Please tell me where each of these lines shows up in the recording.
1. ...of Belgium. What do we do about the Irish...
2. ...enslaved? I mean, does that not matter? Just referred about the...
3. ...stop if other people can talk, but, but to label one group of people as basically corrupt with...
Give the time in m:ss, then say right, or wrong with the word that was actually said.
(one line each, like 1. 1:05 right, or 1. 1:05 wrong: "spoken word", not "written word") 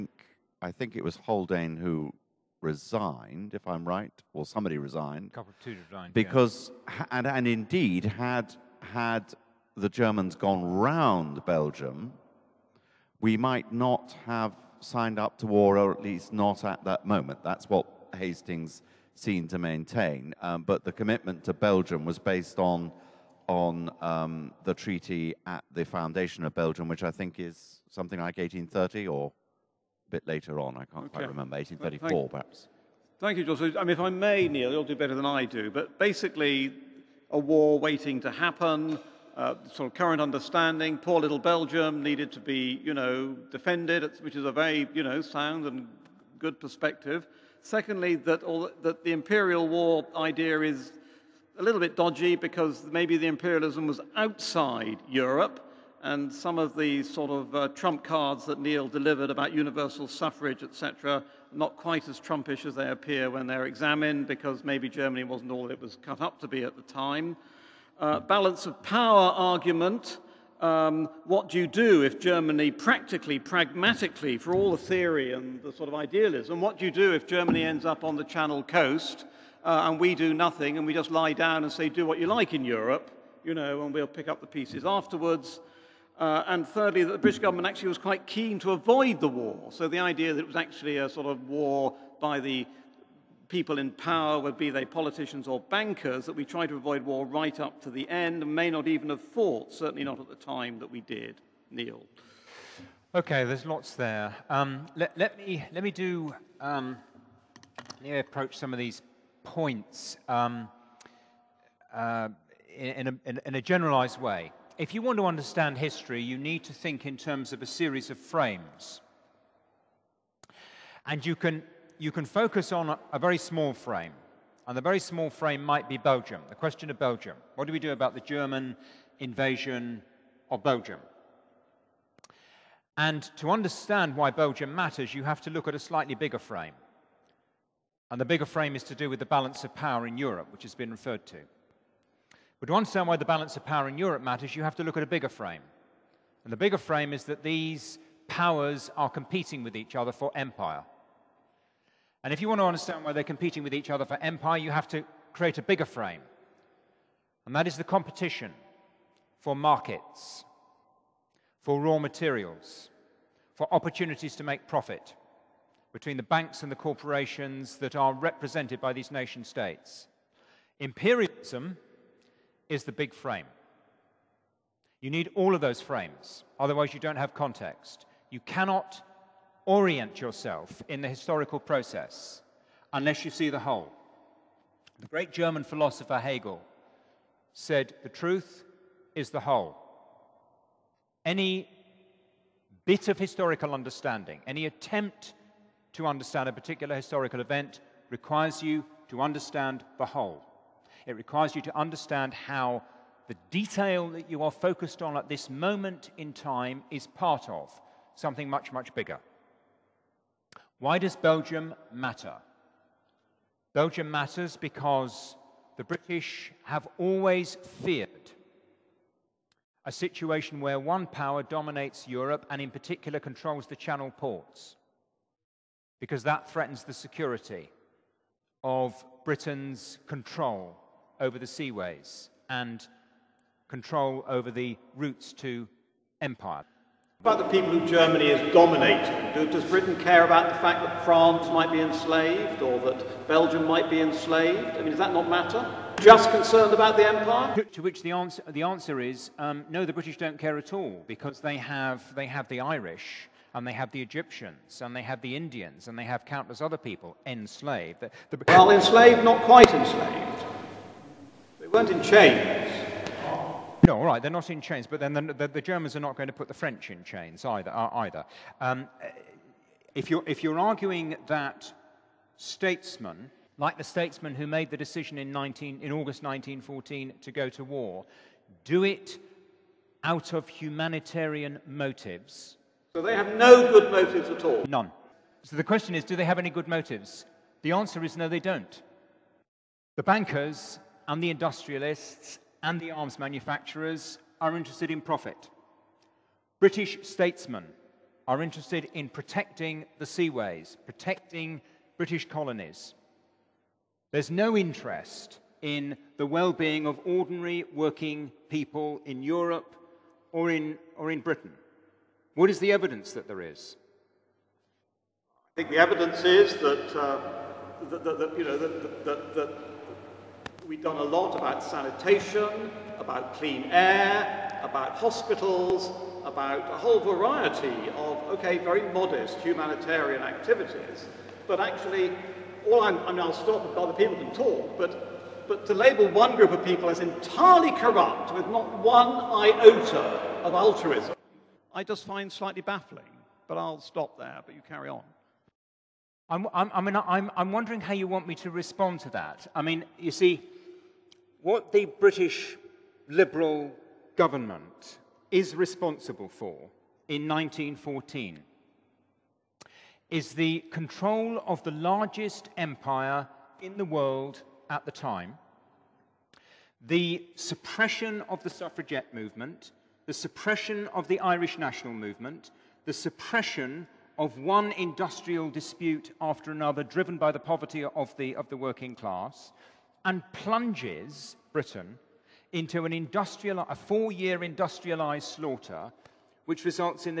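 1. 2:06 wrong: "German", not "Irish"
2. 4:04 wrong: "concerned", not "referred"
3. 5:33 wrong: "entirely", not "basically".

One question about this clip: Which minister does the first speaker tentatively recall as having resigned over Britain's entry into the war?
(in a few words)
Haldane.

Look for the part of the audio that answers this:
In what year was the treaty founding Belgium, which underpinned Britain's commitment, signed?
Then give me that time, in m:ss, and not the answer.
0:31.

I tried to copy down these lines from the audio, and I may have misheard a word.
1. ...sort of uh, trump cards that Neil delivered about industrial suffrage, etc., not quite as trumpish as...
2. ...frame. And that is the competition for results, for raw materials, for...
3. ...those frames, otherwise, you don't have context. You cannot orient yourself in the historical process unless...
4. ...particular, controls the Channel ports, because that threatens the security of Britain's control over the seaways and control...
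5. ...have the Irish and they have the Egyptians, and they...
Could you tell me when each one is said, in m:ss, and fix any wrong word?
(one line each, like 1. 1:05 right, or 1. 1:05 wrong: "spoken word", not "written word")
1. 0:57 wrong: "universal", not "industrial"
2. 2:35 wrong: "markets", not "results"
3. 2:55 right
4. 3:42 right
5. 4:12 right.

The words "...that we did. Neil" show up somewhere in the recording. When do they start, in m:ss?
1:40.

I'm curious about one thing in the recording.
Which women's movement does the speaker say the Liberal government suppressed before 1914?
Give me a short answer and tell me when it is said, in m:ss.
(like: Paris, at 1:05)
suffragette movement, at 6:08.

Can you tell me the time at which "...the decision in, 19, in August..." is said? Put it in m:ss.
4:34.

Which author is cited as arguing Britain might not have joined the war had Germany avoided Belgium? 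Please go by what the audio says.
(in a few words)
Hastings.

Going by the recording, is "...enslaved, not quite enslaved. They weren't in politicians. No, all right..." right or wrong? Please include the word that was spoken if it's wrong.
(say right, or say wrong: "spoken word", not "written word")
wrong: "chains", not "politicians".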